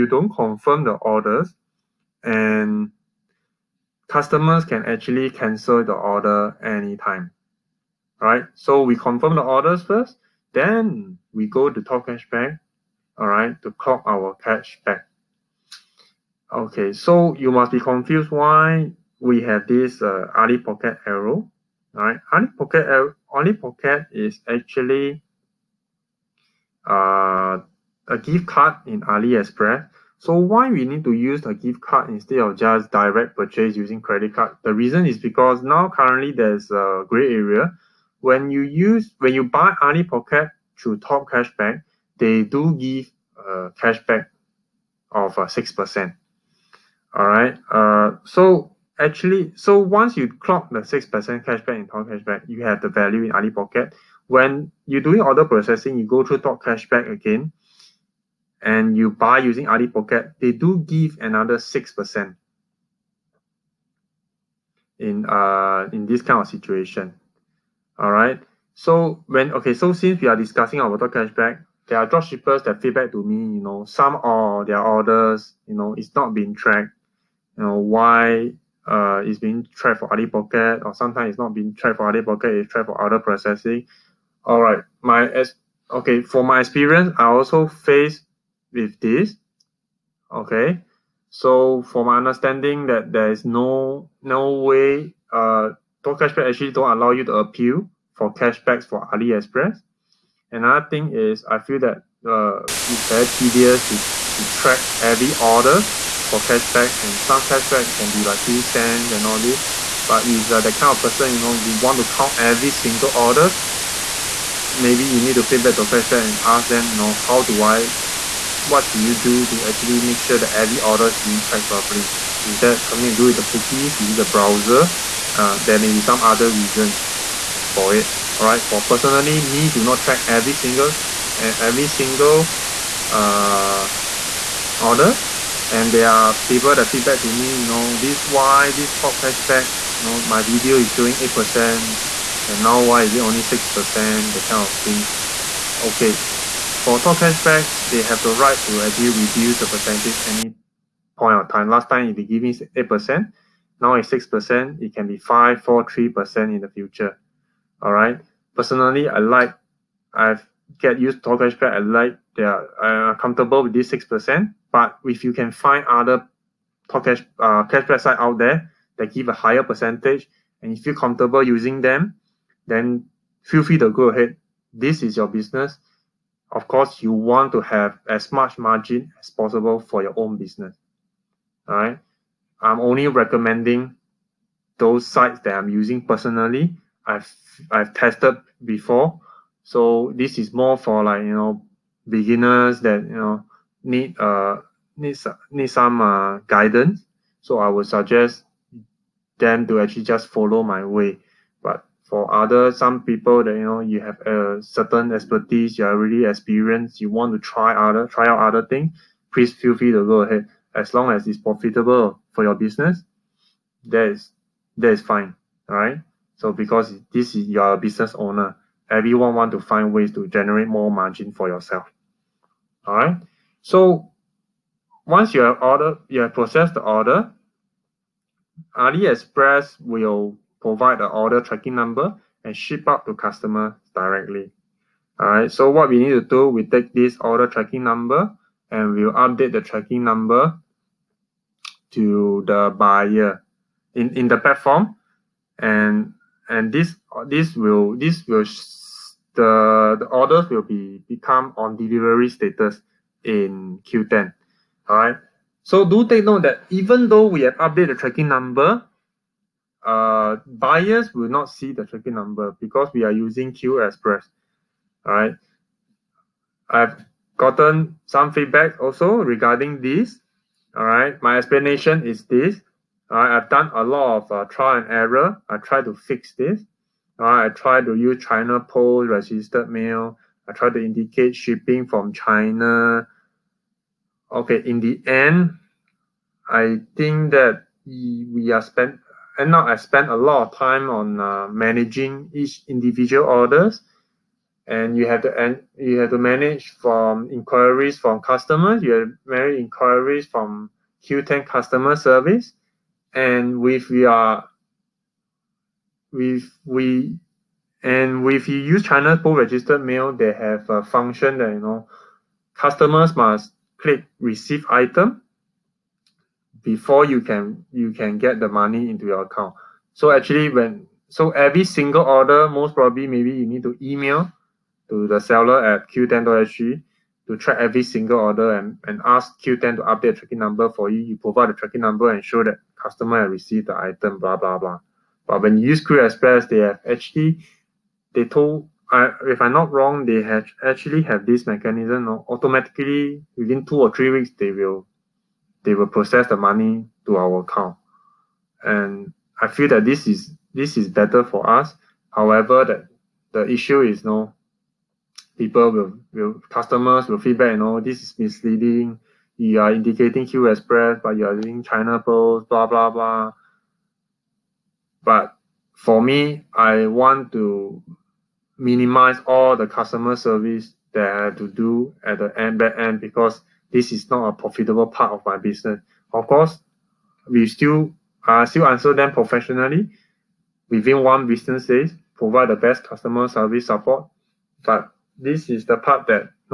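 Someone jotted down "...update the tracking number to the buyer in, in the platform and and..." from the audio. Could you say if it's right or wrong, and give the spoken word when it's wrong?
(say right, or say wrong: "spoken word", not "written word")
right.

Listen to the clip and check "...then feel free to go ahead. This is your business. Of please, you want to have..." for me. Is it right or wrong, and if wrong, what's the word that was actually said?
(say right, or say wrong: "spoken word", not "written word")
wrong: "course", not "please".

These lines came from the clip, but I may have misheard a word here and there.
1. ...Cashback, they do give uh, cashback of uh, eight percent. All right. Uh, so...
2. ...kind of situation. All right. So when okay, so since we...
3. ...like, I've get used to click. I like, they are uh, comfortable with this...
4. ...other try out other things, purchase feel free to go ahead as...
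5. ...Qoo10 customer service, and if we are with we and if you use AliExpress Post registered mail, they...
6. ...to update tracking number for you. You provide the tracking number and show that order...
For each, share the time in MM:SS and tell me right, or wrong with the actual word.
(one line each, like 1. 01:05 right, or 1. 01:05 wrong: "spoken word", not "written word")
1. 00:41 wrong: "six", not "eight"
2. 01:06 right
3. 02:39 wrong: "cashback", not "click"
4. 03:27 wrong: "please", not "purchase"
5. 05:01 wrong: "China", not "AliExpress"
6. 05:29 wrong: "customer", not "order".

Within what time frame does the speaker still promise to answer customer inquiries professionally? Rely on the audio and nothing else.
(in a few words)
1 business day.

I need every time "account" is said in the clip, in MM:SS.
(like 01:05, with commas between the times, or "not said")
05:19, 05:47.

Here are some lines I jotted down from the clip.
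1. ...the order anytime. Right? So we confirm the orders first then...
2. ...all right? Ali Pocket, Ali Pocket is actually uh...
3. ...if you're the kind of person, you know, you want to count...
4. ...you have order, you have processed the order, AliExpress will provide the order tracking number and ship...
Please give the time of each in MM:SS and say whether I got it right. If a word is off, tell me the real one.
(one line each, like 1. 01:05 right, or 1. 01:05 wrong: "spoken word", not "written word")
1. 00:05 right
2. 00:21 right
3. 01:50 right
4. 03:45 right.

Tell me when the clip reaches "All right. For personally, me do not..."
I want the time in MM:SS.
02:08.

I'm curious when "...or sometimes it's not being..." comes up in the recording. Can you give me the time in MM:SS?
01:20.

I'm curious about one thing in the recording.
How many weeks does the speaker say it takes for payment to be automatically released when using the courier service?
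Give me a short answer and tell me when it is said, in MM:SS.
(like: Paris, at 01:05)
2 or 3 weeks, at 05:43.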